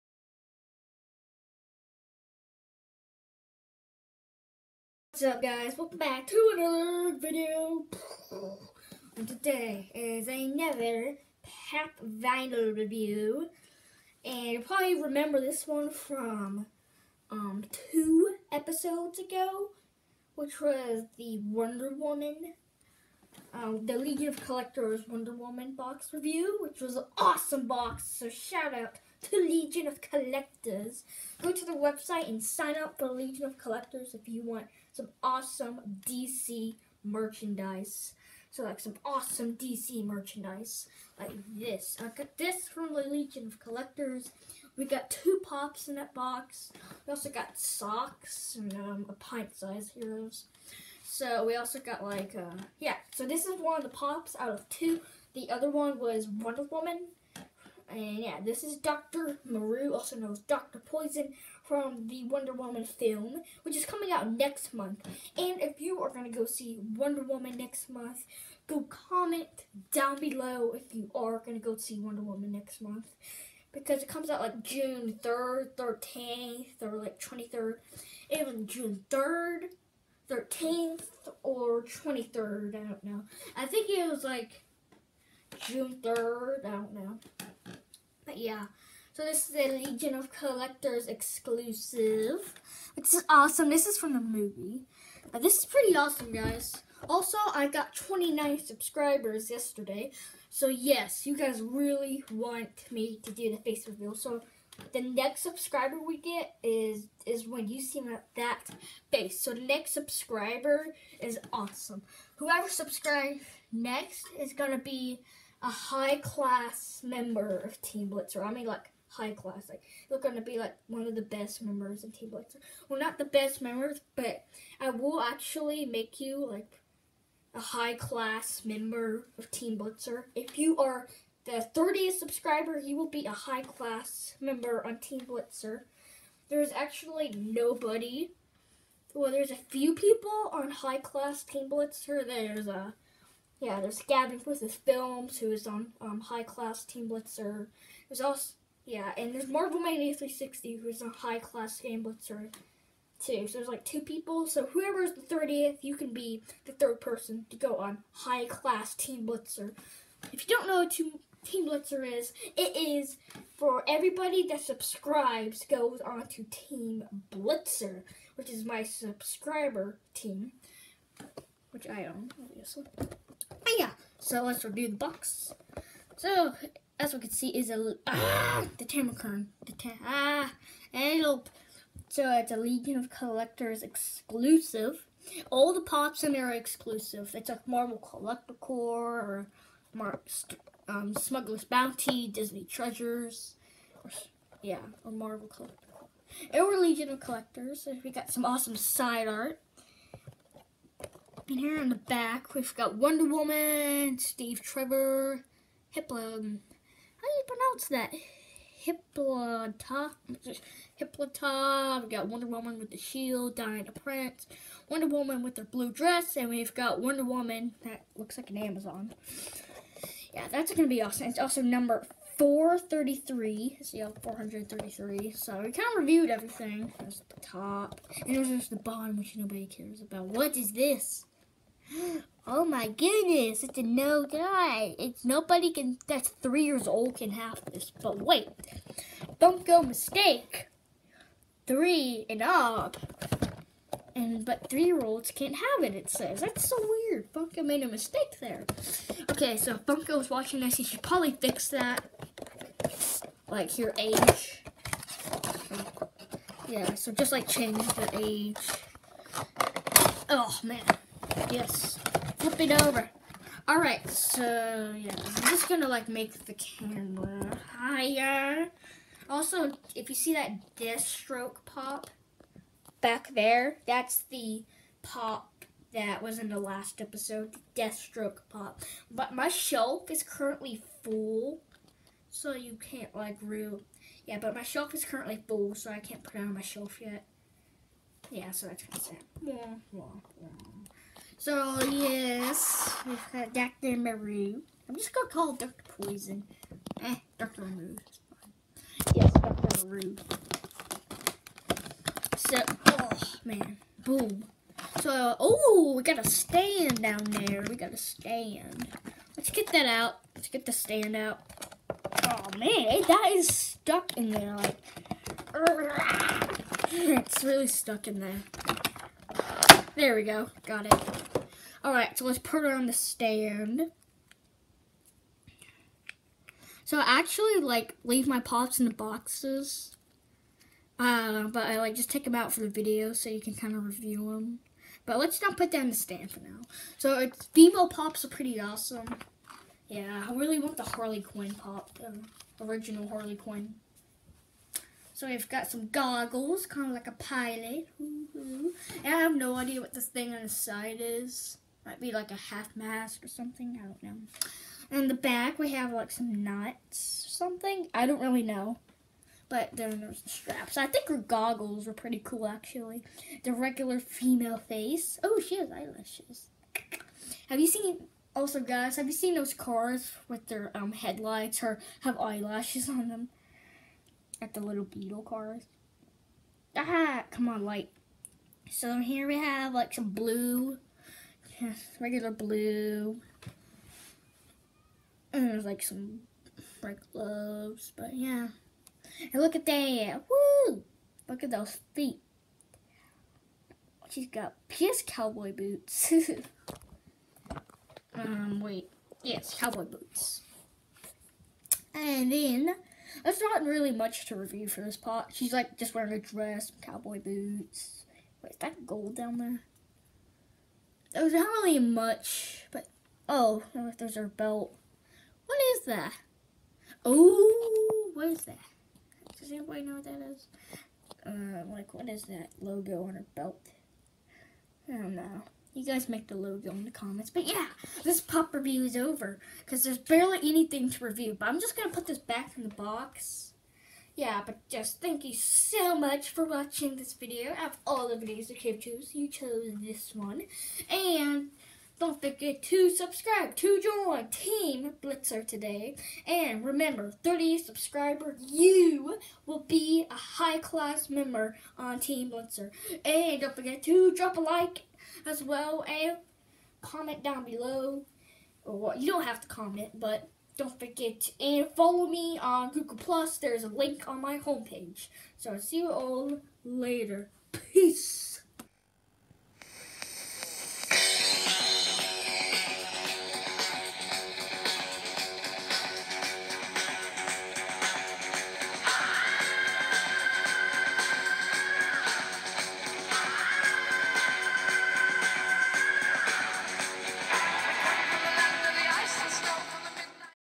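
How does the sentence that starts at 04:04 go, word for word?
And, but three-year-olds can't have it, it says.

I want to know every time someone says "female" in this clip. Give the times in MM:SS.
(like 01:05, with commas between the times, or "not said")
05:37, 06:03.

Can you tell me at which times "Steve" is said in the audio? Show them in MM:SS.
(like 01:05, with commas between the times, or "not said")
03:24.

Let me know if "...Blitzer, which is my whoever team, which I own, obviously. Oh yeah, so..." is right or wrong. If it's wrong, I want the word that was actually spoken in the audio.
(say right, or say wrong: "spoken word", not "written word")
wrong: "subscriber", not "whoever".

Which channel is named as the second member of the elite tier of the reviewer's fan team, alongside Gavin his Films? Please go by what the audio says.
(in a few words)
Marvel Mania 360.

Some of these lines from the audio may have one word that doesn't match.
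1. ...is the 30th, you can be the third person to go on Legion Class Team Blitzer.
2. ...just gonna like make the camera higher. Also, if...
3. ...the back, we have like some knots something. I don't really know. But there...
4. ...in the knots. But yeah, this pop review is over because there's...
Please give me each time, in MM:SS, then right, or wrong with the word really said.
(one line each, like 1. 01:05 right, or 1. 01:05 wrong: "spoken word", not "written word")
1. 02:35 wrong: "High", not "Legion"
2. 04:25 right
3. 05:55 right
4. 07:06 wrong: "comments", not "knots".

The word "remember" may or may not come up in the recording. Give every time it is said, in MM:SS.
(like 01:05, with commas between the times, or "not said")
00:14, 07:26.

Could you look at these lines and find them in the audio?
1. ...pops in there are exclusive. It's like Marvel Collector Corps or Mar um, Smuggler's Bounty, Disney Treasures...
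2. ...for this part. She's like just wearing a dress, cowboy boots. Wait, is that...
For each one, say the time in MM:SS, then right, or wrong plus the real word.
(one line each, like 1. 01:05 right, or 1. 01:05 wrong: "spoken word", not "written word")
1. 03:05 right
2. 06:44 right.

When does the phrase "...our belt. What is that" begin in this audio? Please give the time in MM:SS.
06:54.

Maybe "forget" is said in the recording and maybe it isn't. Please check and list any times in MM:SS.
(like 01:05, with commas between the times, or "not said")
07:22, 07:33, 07:40.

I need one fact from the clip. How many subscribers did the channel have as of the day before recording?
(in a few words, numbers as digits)
29.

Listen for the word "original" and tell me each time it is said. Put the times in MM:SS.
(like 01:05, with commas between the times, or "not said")
05:42.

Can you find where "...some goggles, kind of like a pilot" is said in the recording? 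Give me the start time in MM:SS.
05:45.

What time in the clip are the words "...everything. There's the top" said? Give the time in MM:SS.
03:46.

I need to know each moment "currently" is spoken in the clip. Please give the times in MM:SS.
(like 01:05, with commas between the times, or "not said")
04:40, 04:45.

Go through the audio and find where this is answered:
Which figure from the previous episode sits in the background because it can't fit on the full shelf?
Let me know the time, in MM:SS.
04:37.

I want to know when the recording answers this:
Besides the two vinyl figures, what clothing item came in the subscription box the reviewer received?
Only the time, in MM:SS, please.
00:47.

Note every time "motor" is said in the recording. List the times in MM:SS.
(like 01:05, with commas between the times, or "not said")
not said.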